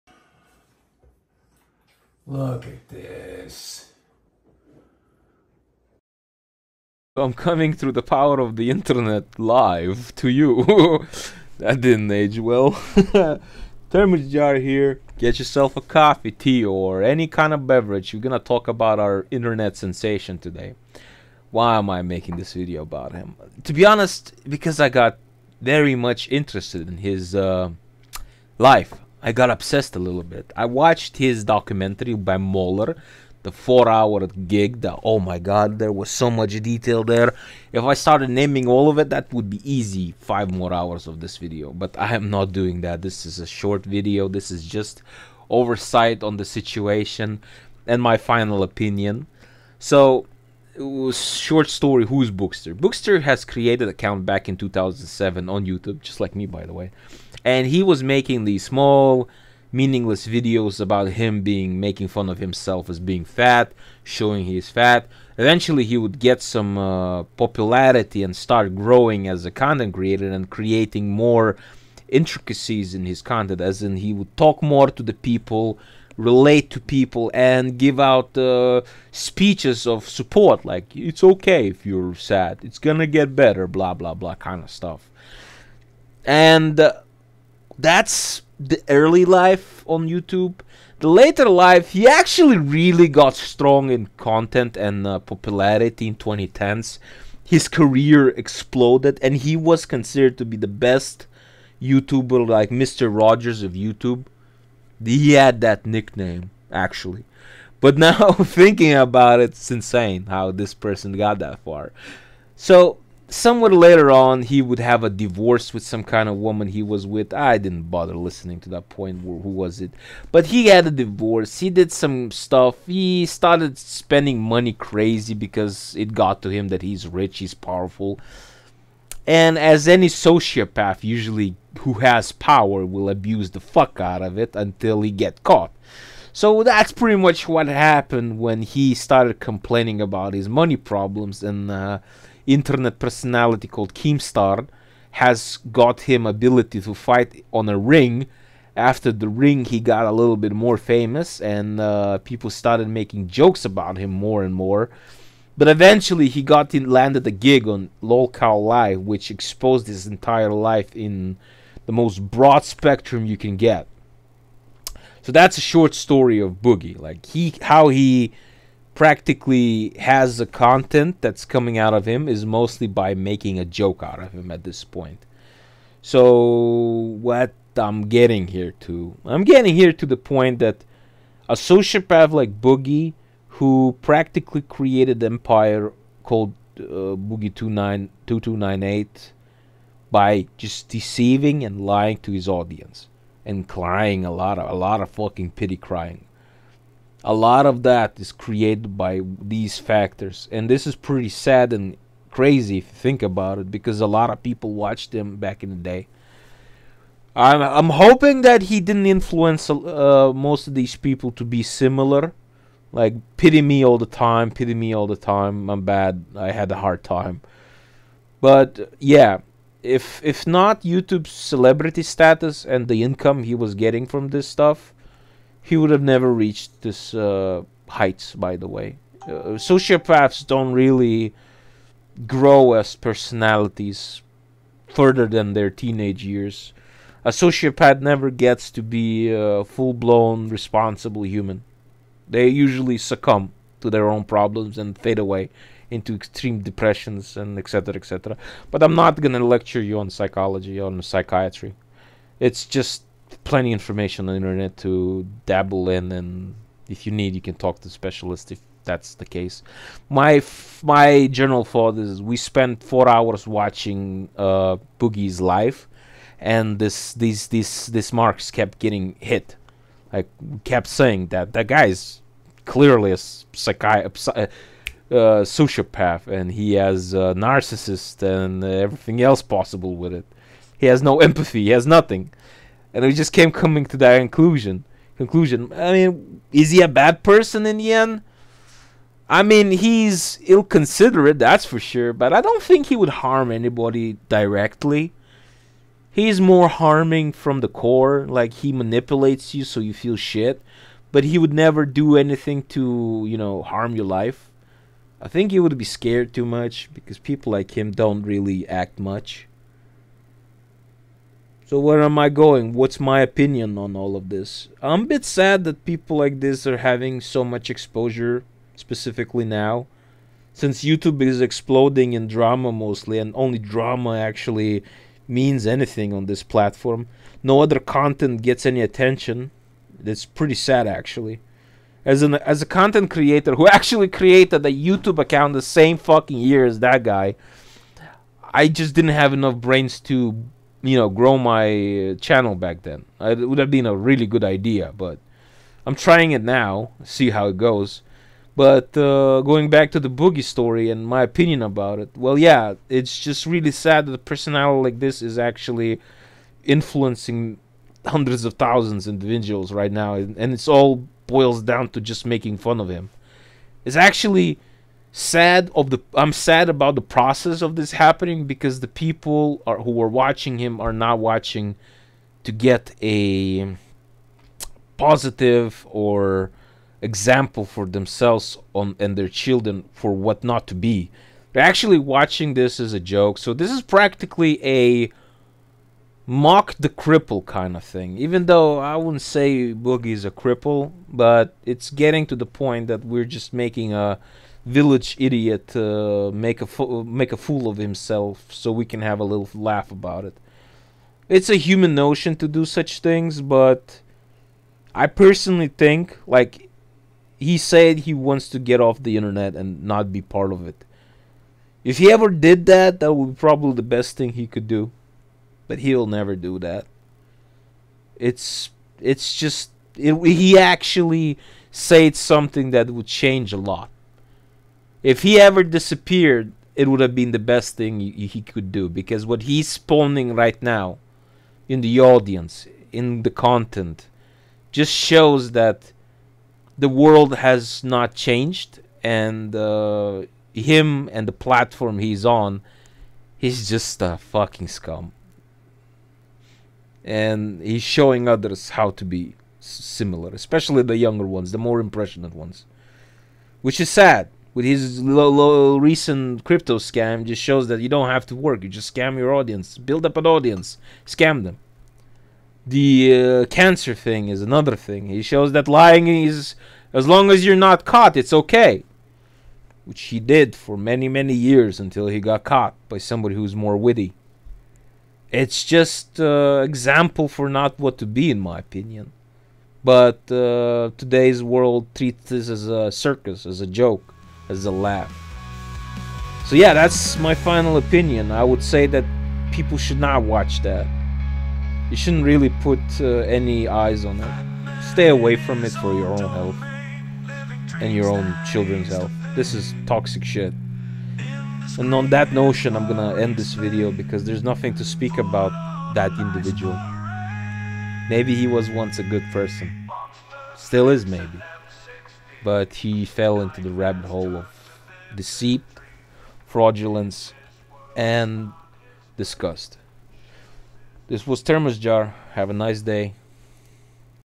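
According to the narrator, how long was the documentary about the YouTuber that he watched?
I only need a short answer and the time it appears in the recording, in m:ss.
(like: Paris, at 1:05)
4 hours, at 0:33.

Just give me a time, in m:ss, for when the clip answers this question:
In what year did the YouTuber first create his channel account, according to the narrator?
0:54.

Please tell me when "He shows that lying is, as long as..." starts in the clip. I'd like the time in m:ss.
7:45.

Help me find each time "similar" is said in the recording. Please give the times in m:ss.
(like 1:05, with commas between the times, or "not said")
3:31, 7:29.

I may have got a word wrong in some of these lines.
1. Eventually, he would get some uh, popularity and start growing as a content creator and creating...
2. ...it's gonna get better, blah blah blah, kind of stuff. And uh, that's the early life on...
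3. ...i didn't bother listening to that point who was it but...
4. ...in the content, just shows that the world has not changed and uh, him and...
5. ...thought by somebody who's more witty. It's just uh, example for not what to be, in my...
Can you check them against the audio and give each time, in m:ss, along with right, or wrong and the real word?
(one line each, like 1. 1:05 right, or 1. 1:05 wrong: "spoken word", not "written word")
1. 1:05 right
2. 1:22 right
3. 1:57 right
4. 7:12 right
5. 7:52 wrong: "caught", not "thought".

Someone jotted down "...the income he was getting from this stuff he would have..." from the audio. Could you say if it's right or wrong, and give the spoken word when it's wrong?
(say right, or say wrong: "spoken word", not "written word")
right.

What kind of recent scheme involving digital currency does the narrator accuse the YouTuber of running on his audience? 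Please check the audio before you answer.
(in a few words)
crypto scam.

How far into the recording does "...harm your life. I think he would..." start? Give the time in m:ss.
5:03.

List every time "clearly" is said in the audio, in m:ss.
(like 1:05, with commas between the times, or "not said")
4:32.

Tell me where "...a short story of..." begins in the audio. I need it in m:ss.
2:45.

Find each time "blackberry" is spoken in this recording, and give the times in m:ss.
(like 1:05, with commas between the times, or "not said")
not said.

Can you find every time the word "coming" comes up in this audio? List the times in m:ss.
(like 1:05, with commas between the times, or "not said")
0:07, 2:51, 4:43.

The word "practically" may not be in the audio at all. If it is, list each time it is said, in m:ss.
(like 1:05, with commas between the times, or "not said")
2:48, 3:04, 6:23.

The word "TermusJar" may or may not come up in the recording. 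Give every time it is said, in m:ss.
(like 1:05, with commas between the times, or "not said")
0:13, 8:41.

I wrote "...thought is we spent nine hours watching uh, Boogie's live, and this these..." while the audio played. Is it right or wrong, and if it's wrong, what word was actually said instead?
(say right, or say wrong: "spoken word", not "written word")
wrong: "four", not "nine".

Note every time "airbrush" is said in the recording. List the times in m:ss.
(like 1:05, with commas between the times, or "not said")
not said.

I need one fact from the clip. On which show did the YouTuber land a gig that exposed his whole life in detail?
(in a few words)
LolCow Live.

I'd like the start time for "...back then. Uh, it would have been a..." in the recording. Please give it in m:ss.
5:42.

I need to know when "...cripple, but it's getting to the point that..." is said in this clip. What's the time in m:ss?
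6:30.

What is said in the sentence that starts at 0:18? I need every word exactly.
We're gonna talk about our internet sensation today.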